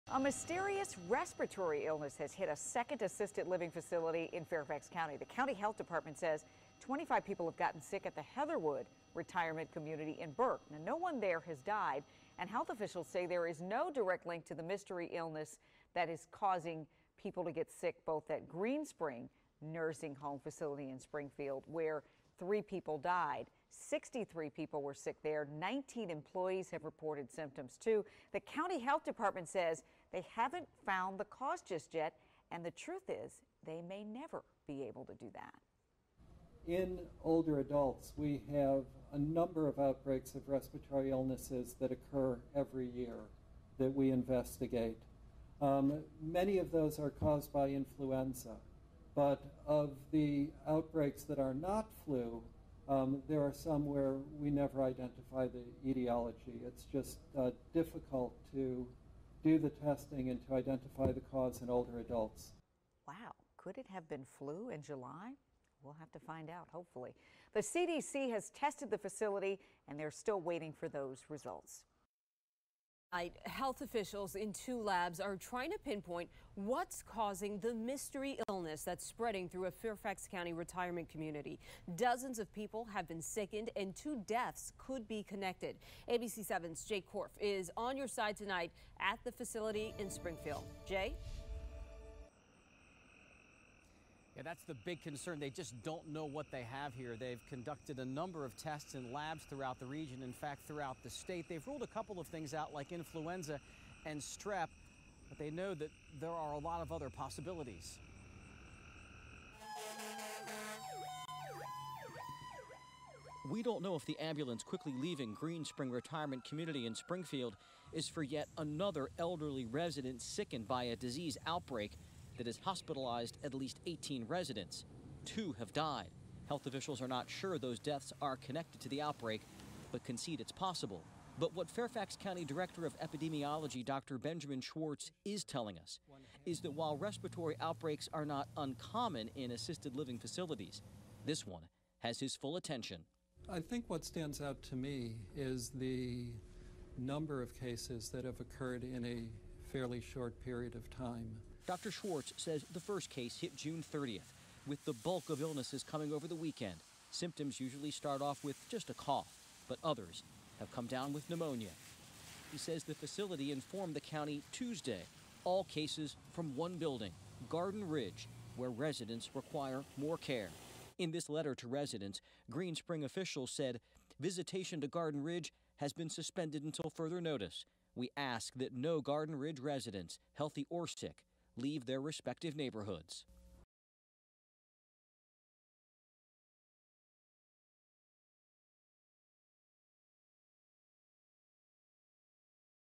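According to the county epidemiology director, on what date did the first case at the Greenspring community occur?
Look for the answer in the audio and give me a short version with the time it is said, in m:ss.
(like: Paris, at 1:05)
June 30, at 2:33.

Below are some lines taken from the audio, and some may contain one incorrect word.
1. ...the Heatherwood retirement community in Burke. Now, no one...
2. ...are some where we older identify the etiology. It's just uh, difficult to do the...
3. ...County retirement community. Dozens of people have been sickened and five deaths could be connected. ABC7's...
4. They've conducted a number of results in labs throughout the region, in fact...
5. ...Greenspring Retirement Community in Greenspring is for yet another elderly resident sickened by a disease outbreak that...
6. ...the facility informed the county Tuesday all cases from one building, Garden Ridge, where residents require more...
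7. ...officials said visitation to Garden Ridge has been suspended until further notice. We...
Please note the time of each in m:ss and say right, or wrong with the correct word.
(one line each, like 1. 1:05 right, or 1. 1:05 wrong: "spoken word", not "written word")
1. 0:08 right
2. 0:53 wrong: "never", not "older"
3. 1:20 wrong: "two", not "five"
4. 1:37 wrong: "tests", not "results"
5. 1:55 wrong: "Springfield", not "Greenspring"
6. 2:42 right
7. 2:53 right.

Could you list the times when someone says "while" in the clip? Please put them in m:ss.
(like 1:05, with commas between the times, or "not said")
2:16.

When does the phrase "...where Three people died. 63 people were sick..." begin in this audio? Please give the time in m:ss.
0:21.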